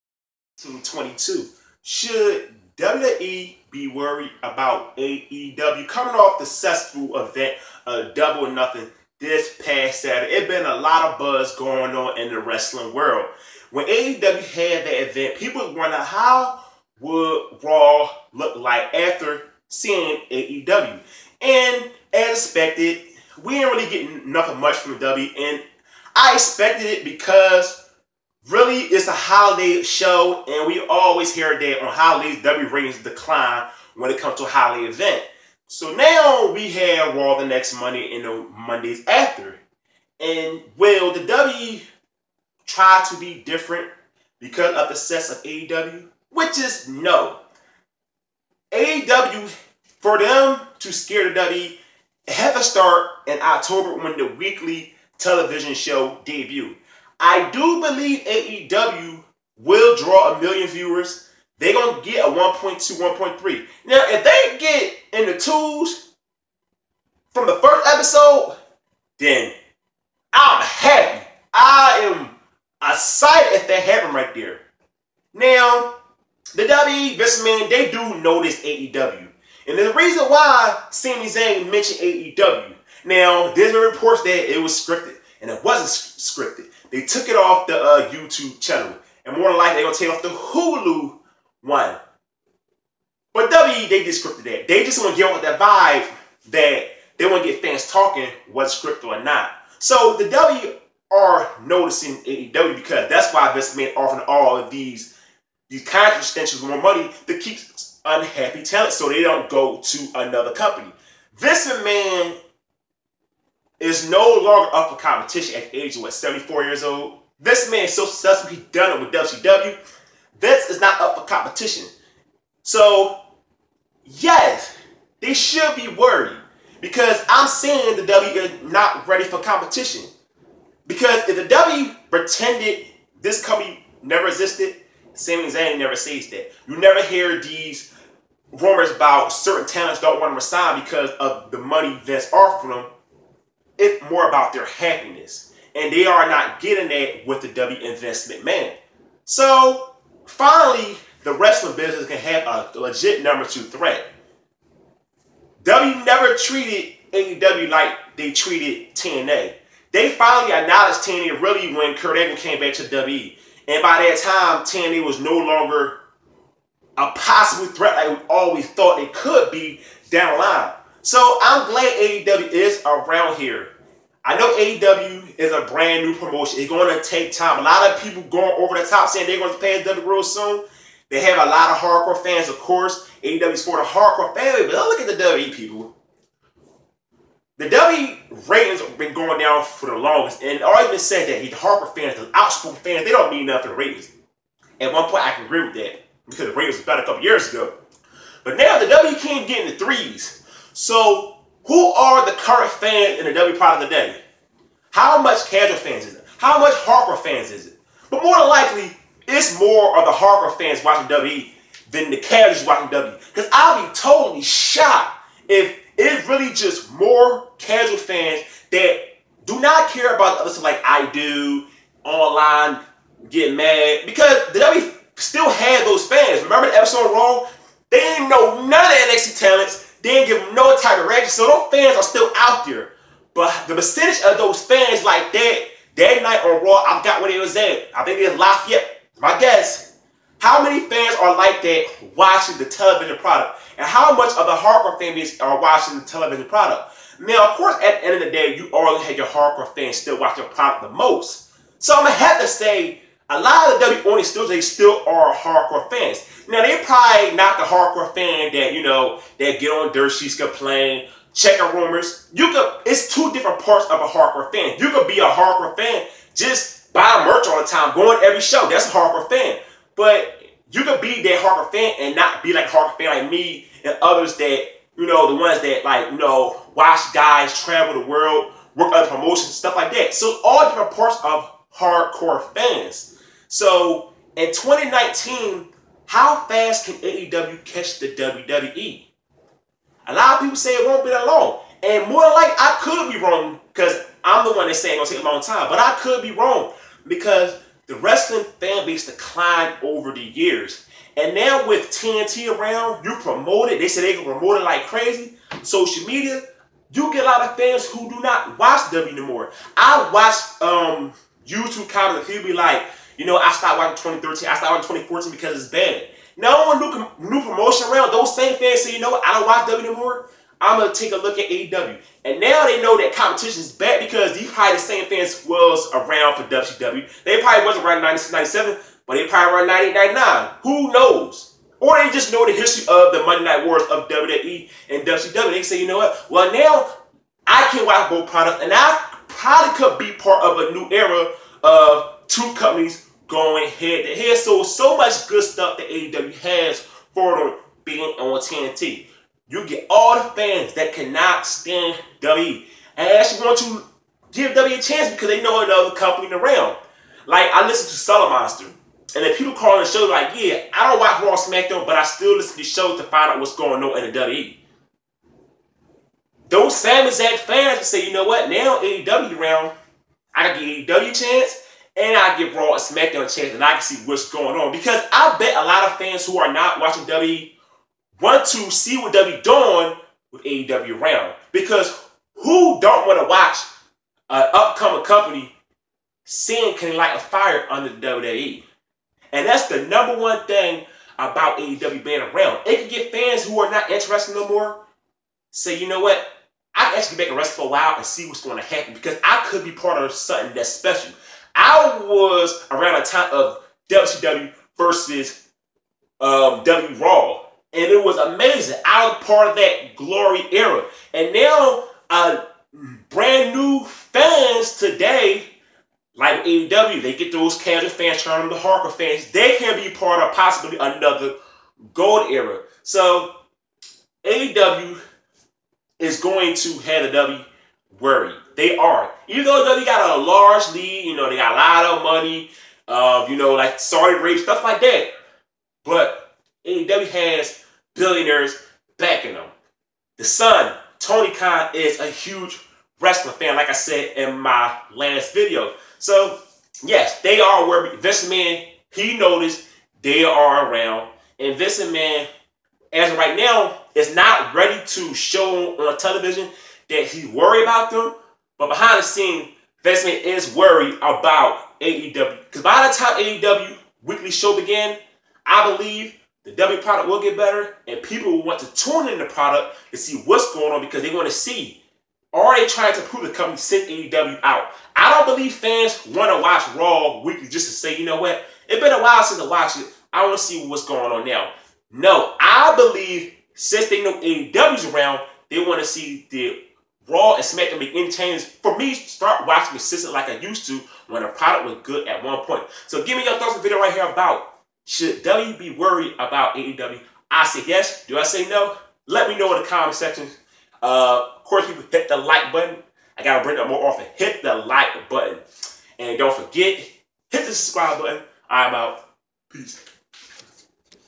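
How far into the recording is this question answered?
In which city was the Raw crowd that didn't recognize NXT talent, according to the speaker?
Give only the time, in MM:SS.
03:58.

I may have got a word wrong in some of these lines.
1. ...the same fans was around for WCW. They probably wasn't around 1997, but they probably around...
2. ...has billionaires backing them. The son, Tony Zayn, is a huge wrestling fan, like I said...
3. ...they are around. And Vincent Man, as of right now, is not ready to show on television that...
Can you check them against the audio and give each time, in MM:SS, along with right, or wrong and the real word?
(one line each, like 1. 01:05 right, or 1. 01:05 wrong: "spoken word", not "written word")
1. 05:24 right
2. 07:17 wrong: "Khan", not "Zayn"
3. 07:30 right.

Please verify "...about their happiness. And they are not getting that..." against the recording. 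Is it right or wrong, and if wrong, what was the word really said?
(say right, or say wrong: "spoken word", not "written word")
right.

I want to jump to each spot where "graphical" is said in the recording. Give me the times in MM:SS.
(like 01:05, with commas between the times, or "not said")
not said.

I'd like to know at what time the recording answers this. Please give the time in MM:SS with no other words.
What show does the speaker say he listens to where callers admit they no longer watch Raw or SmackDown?
05:57.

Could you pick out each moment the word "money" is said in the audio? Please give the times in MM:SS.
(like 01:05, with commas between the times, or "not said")
01:46, 02:21, 07:12.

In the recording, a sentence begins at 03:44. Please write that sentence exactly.
Because the WWE still had those fans.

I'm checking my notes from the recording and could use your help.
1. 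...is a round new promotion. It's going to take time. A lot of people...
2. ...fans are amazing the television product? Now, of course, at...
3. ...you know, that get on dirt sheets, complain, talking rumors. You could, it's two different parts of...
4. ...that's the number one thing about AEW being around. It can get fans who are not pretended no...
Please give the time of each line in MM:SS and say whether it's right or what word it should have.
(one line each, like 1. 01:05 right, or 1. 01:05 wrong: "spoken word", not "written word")
1. 02:55 wrong: "brand", not "round"
2. 04:04 wrong: "watching", not "amazing"
3. 04:18 wrong: "checking", not "talking"
4. 06:29 wrong: "interested", not "pretended".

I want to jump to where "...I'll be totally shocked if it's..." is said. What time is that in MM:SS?
03:33.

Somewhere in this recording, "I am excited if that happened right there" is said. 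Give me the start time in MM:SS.
01:11.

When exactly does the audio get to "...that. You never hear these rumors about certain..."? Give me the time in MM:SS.
02:16.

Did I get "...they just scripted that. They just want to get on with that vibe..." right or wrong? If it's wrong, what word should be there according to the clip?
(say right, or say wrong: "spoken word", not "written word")
right.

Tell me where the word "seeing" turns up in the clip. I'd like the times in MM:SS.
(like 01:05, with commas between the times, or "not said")
00:19, 02:07, 06:26.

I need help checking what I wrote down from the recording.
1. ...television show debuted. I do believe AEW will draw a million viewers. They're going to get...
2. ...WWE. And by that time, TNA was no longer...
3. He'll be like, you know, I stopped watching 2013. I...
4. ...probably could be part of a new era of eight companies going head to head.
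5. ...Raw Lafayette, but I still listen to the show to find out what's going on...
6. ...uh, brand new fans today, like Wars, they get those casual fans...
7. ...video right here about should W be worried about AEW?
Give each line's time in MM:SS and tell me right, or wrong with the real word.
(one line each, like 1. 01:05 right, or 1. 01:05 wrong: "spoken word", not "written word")
1. 00:55 right
2. 02:42 right
3. 05:12 right
4. 05:39 wrong: "two", not "eight"
5. 06:01 wrong: "SmackDown", not "Lafayette"
6. 06:52 wrong: "AEW", not "Wars"
7. 08:13 right.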